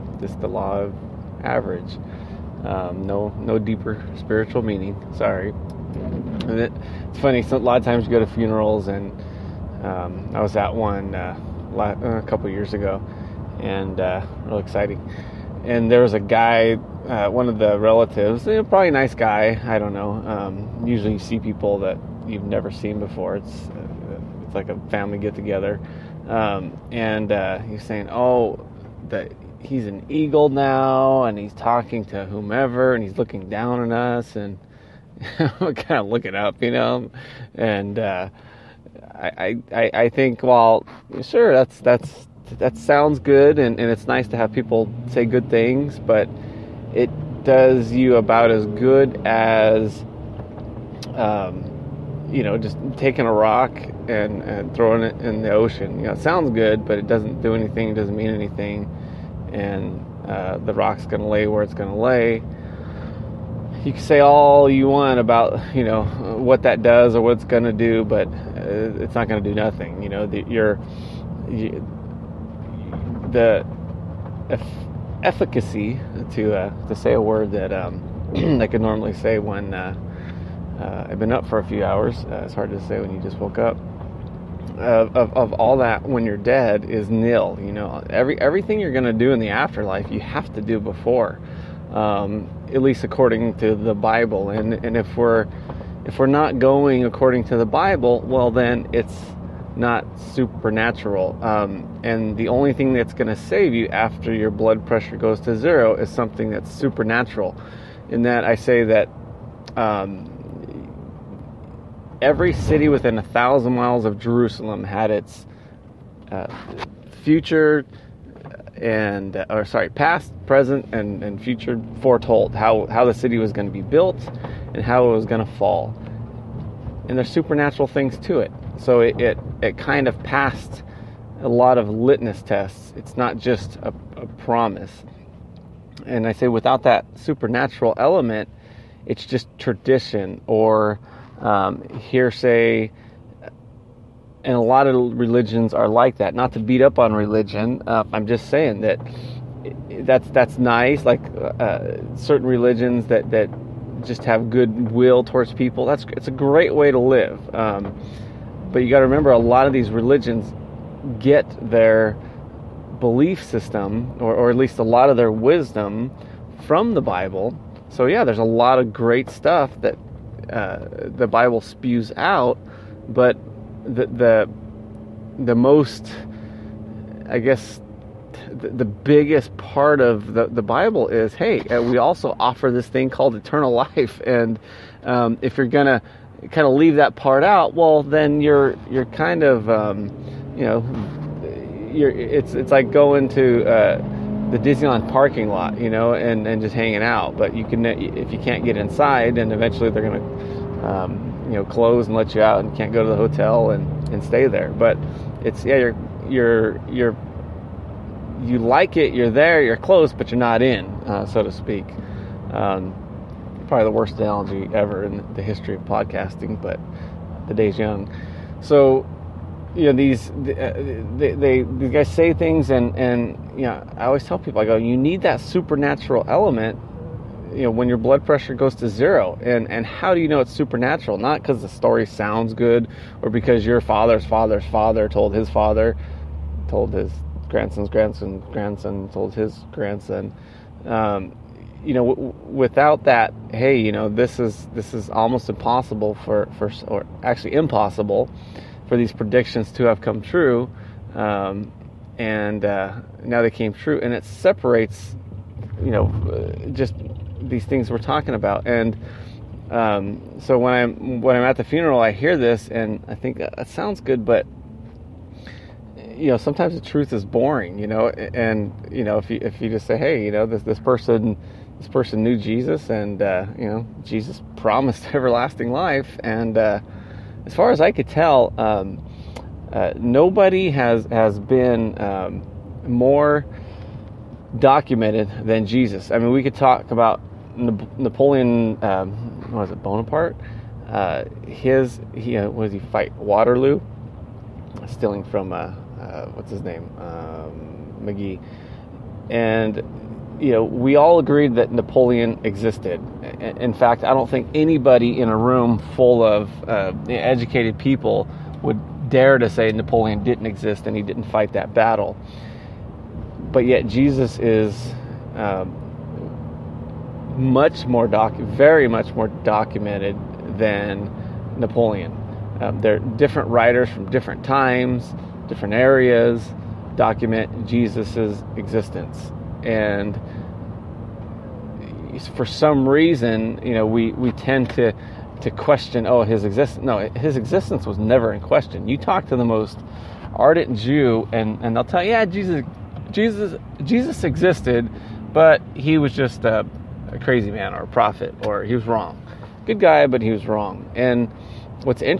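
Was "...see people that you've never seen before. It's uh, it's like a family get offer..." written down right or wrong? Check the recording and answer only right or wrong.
wrong.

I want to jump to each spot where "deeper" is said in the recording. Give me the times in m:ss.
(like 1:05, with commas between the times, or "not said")
0:03.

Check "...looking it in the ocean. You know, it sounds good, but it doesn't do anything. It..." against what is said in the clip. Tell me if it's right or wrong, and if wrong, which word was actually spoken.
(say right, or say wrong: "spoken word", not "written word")
wrong: "throwing", not "looking".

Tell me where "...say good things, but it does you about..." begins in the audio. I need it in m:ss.
0:45.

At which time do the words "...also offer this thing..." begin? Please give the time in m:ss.
3:01.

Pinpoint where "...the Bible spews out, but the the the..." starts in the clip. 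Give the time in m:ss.
2:51.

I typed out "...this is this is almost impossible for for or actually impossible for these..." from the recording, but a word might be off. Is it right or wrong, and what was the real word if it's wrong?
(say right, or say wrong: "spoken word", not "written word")
right.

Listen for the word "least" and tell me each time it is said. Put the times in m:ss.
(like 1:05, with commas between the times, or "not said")
1:32, 2:44.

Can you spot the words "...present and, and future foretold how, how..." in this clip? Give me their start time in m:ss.
2:00.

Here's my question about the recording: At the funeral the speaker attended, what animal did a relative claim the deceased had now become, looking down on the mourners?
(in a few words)
an eagle.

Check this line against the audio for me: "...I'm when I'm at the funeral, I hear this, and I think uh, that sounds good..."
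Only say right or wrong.
right.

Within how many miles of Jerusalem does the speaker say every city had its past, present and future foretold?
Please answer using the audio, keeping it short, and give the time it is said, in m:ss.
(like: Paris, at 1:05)
1000, at 1:53.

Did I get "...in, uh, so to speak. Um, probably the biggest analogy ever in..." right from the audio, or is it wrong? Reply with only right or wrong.
wrong.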